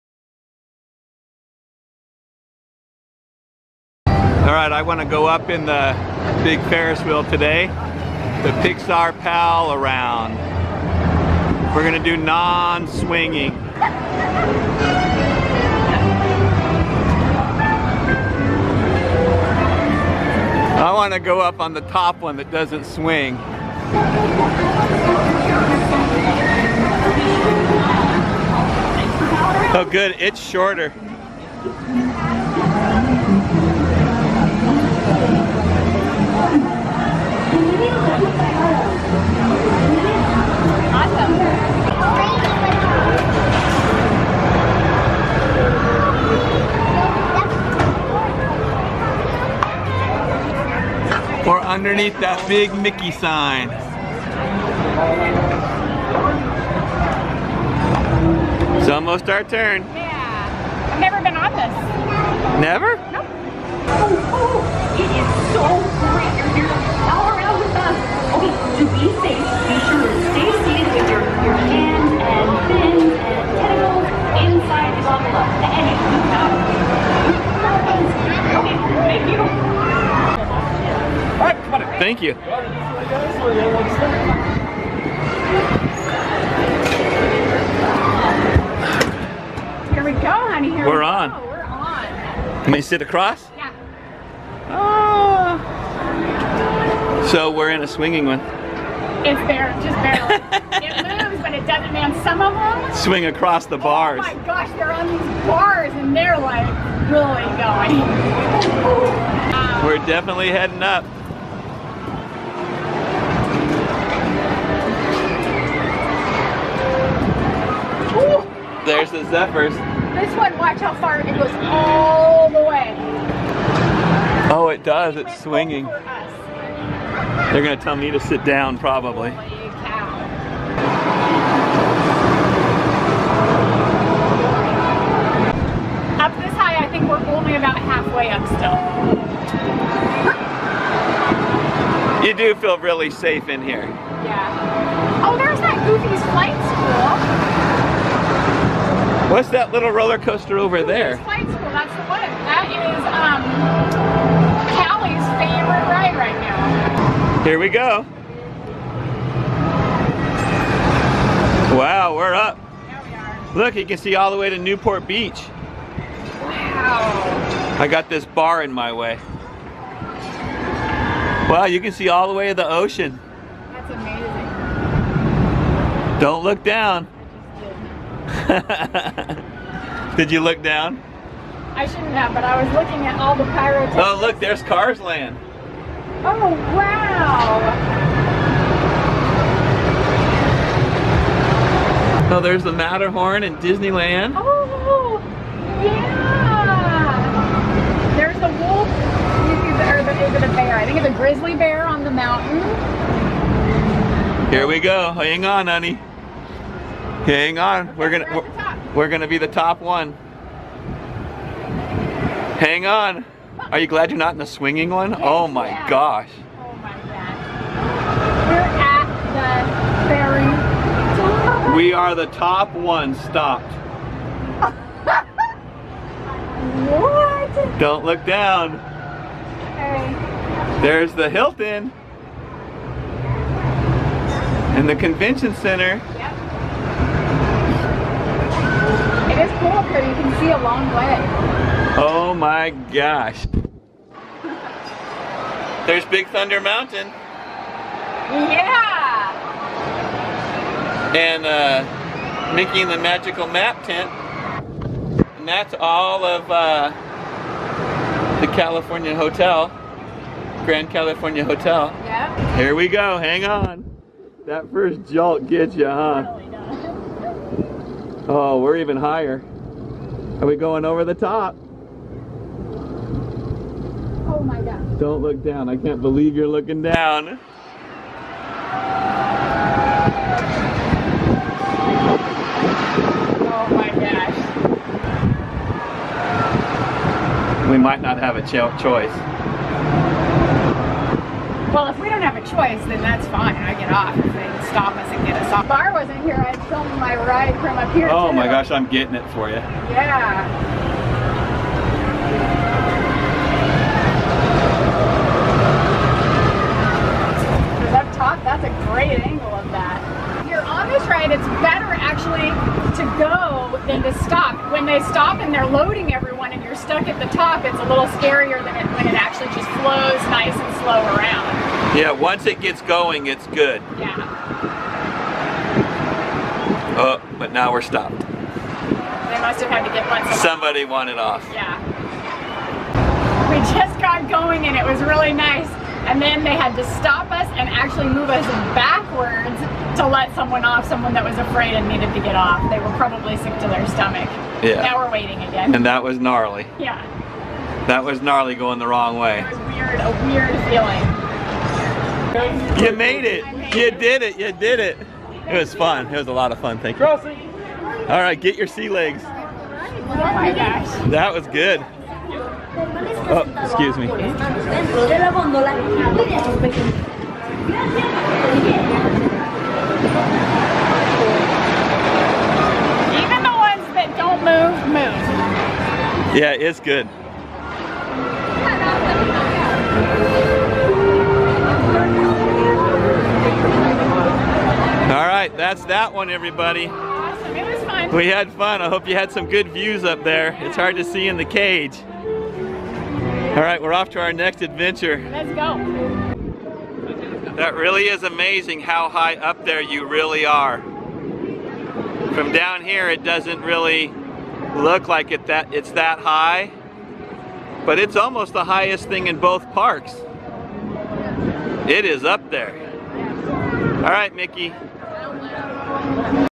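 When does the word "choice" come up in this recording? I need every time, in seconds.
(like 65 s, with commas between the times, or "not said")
288 s, 292 s.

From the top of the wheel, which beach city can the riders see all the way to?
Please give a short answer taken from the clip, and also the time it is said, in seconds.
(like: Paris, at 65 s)
Newport Beach, at 164 s.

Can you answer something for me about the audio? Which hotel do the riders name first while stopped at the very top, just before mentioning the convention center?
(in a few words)
Hilton.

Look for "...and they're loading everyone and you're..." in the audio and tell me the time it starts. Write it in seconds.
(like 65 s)
315 s.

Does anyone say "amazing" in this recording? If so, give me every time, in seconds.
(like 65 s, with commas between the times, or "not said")
173 s, 398 s.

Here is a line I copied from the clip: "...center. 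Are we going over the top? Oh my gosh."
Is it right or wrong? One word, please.
wrong.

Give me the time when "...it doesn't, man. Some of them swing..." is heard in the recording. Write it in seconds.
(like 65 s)
101 s.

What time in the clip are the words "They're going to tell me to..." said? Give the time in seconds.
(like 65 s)
125 s.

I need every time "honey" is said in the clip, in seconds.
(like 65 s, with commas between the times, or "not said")
90 s, 205 s.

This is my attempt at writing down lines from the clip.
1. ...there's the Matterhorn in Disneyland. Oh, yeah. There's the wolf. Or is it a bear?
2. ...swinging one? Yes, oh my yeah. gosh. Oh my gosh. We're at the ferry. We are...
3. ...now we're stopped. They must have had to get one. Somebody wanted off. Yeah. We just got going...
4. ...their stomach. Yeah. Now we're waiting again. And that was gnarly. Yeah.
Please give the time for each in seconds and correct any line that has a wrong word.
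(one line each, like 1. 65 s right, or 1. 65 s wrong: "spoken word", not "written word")
1. 192 s right
2. 214 s right
3. 327 s right
4. 343 s right.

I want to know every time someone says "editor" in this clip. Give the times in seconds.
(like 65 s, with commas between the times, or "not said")
not said.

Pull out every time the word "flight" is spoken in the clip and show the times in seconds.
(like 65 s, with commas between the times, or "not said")
146 s, 151 s.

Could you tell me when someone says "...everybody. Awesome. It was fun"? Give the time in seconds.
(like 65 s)
386 s.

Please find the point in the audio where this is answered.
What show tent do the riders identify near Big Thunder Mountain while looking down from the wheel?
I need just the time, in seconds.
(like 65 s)
252 s.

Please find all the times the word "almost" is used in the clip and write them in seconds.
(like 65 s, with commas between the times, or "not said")
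58 s, 408 s.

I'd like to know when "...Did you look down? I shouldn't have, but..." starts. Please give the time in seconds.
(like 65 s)
180 s.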